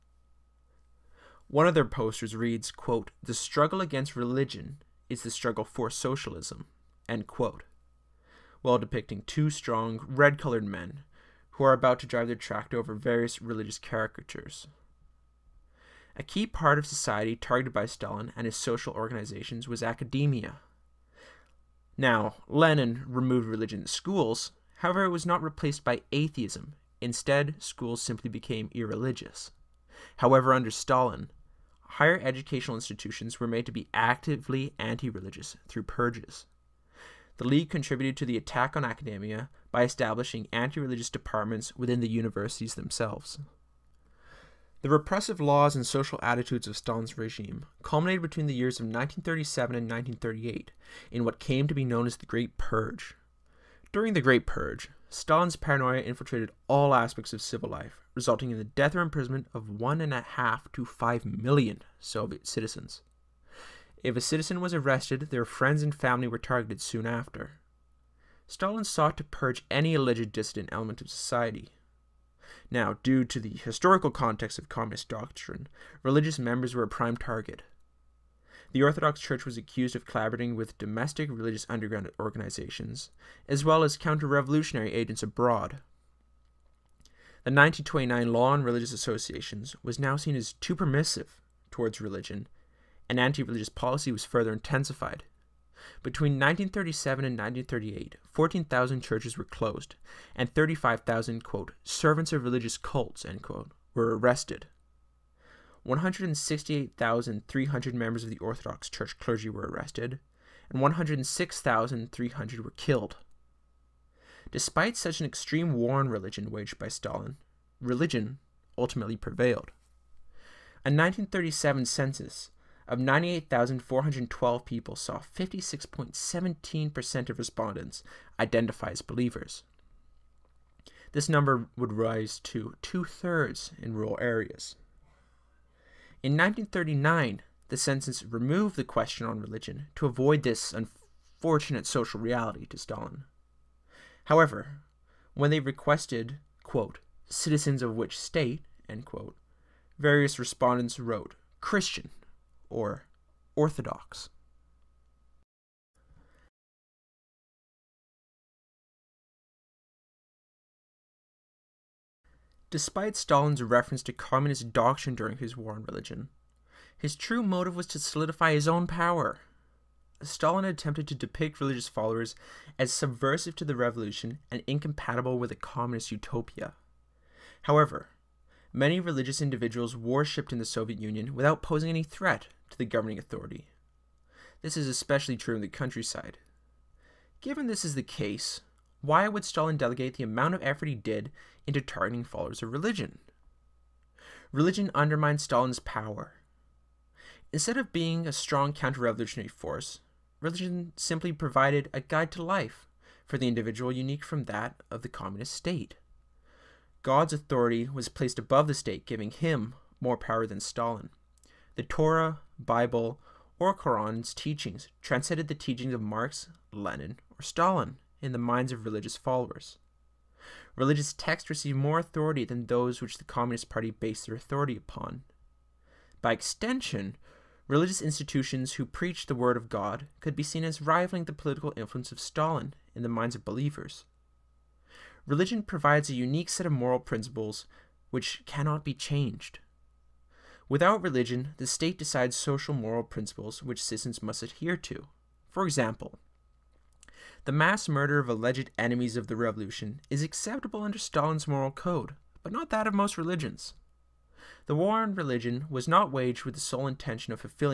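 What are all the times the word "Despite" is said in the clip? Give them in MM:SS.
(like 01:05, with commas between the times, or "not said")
01:54, 02:42.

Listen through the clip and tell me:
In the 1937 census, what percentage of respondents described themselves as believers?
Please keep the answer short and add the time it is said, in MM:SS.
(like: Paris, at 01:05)
56.17%, at 02:05.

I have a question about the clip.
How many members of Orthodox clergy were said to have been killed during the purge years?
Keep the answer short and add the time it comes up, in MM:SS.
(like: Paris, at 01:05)
106300, at 01:50.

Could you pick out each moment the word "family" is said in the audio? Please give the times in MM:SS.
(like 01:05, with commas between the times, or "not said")
01:05.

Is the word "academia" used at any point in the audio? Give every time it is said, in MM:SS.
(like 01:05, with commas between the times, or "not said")
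00:19, 00:38.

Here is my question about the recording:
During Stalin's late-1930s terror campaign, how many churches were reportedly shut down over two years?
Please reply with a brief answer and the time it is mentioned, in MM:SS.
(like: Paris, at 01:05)
14000, at 01:38.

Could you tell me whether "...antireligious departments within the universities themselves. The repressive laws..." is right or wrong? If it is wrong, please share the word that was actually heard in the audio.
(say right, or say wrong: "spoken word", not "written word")
wrong: "religious", not "antireligious".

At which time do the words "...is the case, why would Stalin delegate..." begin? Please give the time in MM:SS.
03:07.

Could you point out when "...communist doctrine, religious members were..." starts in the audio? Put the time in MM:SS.
01:14.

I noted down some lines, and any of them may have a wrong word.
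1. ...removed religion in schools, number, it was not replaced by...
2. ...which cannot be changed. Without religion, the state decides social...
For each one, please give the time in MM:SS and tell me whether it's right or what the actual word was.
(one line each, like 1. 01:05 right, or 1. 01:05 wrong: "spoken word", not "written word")
1. 00:23 wrong: "however", not "number"
2. 03:58 right.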